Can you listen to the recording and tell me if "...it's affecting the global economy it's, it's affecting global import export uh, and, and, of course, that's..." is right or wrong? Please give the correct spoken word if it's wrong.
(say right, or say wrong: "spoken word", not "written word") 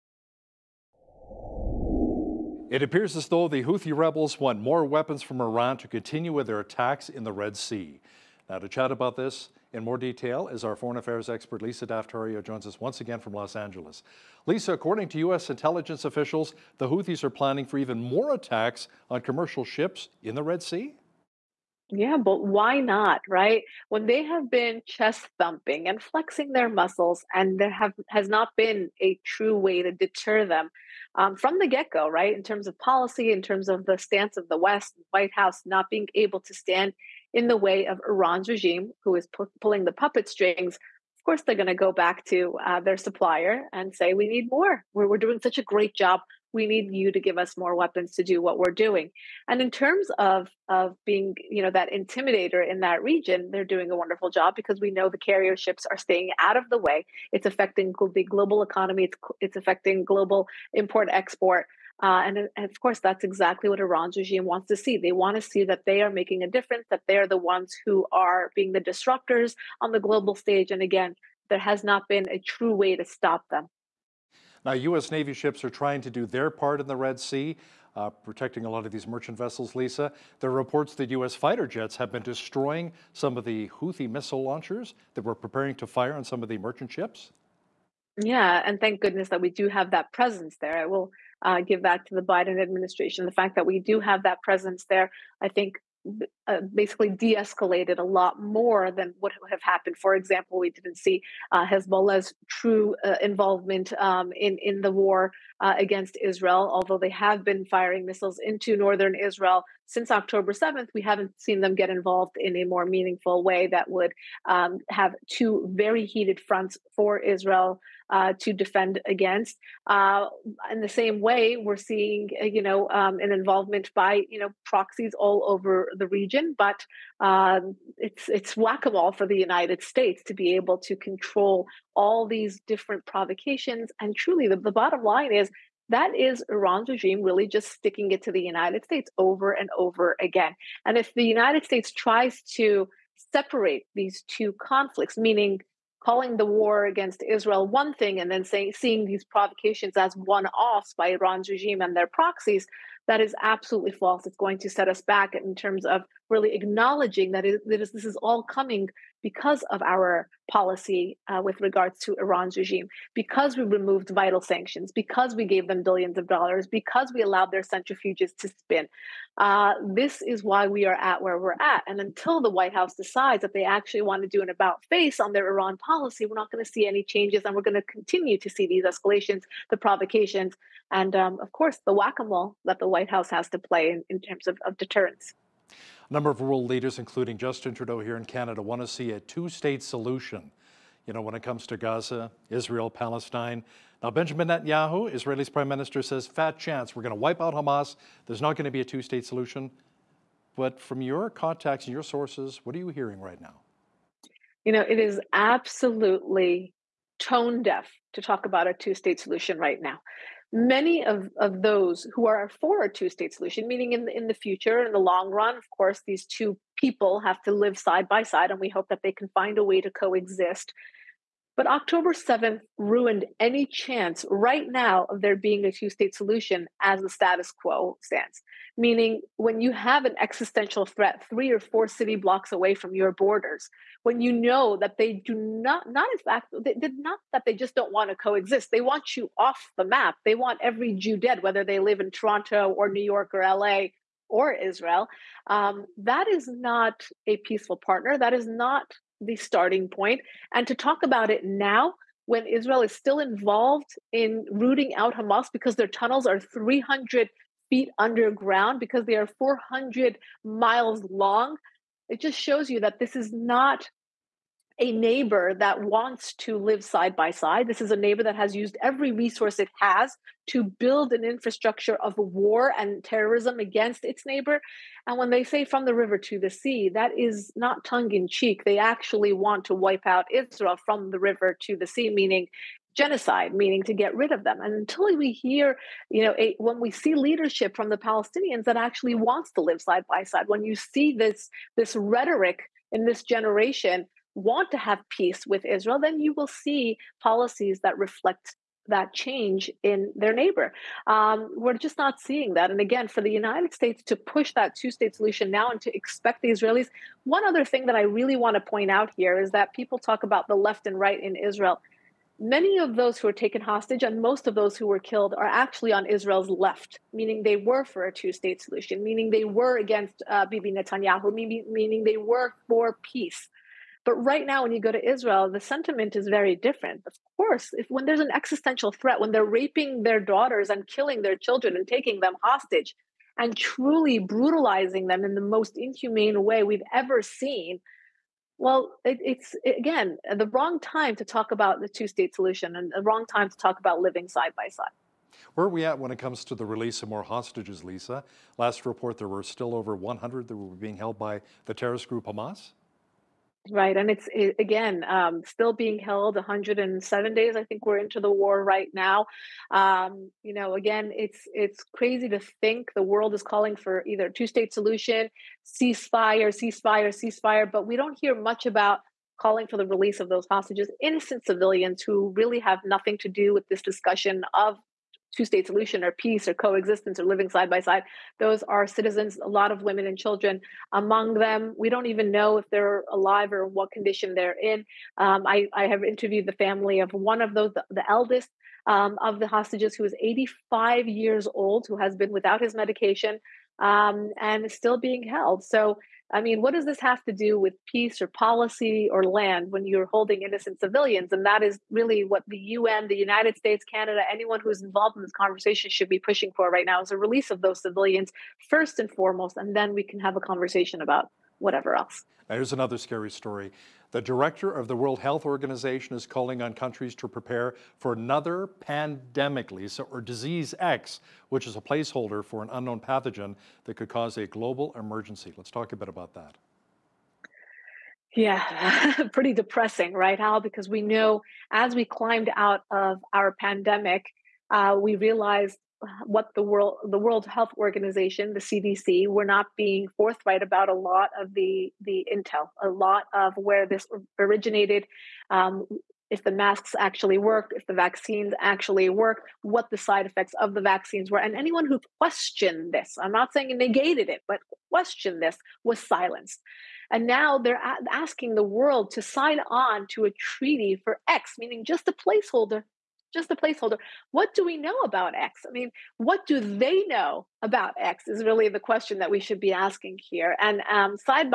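right.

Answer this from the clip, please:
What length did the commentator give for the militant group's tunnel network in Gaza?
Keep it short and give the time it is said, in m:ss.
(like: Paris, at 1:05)
400 miles, at 4:19.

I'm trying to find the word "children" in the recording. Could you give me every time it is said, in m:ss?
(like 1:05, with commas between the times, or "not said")
5:31, 6:20.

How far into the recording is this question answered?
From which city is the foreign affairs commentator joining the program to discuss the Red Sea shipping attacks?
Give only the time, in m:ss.
0:13.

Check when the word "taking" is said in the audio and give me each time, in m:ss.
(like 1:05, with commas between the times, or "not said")
5:31.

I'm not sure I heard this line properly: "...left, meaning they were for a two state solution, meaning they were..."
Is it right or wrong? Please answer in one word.
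right.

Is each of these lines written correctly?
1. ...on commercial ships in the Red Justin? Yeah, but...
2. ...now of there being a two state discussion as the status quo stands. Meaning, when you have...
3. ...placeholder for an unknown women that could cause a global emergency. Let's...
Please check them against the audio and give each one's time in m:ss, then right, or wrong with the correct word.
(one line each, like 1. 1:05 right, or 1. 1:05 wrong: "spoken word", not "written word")
1. 0:19 wrong: "Sea", not "Justin"
2. 3:44 wrong: "solution", not "discussion"
3. 7:01 wrong: "pathogen", not "women".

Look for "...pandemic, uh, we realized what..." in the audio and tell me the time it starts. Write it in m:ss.
7:13.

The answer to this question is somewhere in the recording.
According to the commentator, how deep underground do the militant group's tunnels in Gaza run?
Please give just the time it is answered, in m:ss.
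4:16.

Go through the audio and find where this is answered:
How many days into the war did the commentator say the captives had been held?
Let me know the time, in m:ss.
5:56.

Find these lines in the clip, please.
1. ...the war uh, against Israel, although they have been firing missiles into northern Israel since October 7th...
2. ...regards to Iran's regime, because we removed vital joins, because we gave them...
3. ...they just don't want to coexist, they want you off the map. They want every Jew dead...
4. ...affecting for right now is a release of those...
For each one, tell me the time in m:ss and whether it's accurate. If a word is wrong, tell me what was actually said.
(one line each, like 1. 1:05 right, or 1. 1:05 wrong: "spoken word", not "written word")
1. 1:44 right
2. 2:41 wrong: "sanctions", not "joins"
3. 3:57 right
4. 6:46 wrong: "pushing", not "affecting".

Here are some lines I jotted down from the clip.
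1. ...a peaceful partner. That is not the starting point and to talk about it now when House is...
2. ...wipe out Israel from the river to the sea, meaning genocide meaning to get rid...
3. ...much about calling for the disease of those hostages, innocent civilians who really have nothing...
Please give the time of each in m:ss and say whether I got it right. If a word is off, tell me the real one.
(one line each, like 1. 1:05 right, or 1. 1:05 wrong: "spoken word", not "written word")
1. 4:07 wrong: "Israel", not "House"
2. 4:39 right
3. 6:08 wrong: "release", not "disease".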